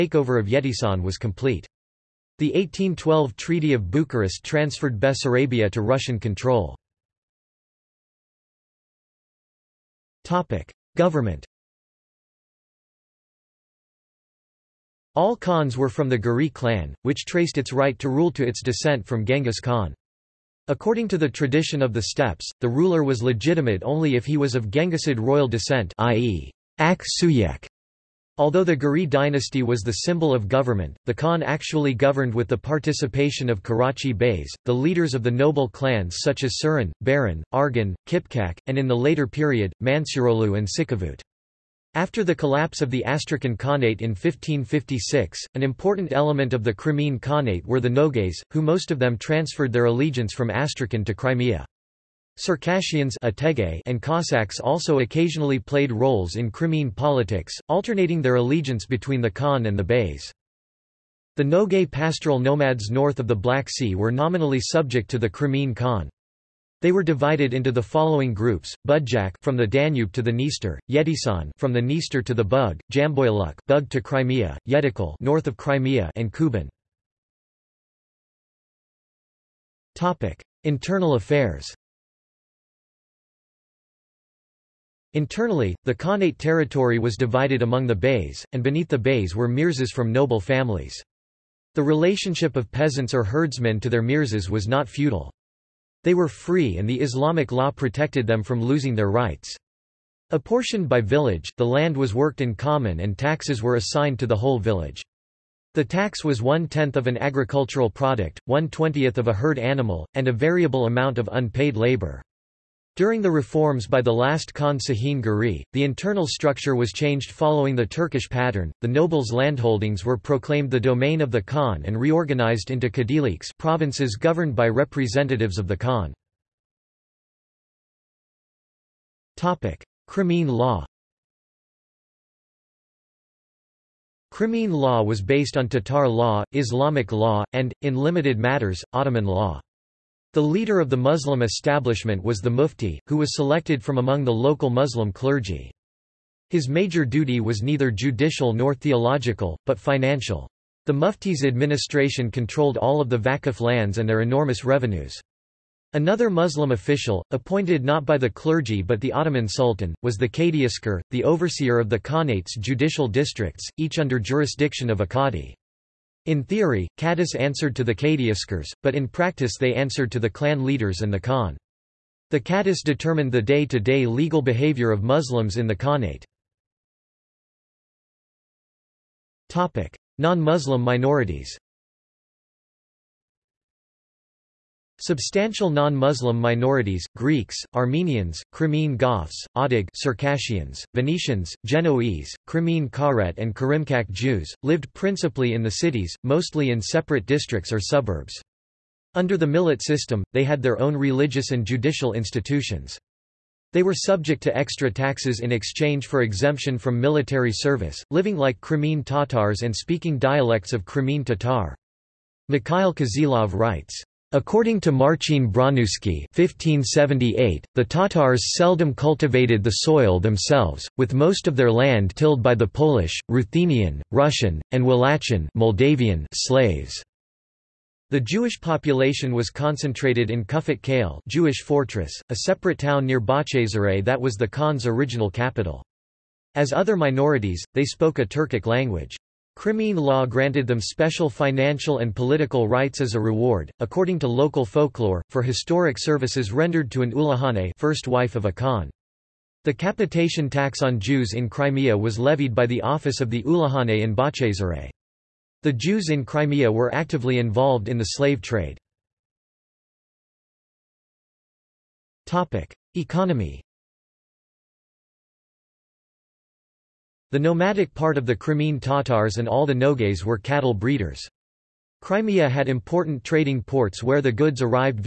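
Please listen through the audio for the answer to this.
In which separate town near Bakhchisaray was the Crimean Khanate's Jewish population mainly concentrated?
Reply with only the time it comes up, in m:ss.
3:50.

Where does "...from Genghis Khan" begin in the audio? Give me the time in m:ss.
0:19.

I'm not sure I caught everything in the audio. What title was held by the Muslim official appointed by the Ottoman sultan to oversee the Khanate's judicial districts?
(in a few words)
Kadiaskar.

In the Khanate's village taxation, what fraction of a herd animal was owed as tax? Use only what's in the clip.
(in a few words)
one-twentieth.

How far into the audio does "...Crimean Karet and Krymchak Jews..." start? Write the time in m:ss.
3:12.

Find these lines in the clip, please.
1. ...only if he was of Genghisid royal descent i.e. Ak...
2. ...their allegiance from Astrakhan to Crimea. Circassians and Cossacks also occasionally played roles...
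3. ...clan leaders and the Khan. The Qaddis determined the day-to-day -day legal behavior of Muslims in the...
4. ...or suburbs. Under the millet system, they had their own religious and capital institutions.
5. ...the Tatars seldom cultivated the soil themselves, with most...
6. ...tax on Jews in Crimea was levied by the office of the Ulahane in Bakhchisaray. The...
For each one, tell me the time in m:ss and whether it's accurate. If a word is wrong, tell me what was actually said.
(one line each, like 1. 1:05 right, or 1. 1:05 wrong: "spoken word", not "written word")
1. 0:23 right
2. 0:49 right
3. 2:50 right
4. 3:17 wrong: "judicial", not "capital"
5. 3:37 right
6. 4:10 right.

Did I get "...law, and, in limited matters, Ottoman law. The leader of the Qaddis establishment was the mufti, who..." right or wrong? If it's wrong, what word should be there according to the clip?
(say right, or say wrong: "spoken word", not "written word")
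wrong: "Muslim", not "Qaddis".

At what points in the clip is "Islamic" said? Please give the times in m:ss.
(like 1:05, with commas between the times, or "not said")
1:36, 2:16.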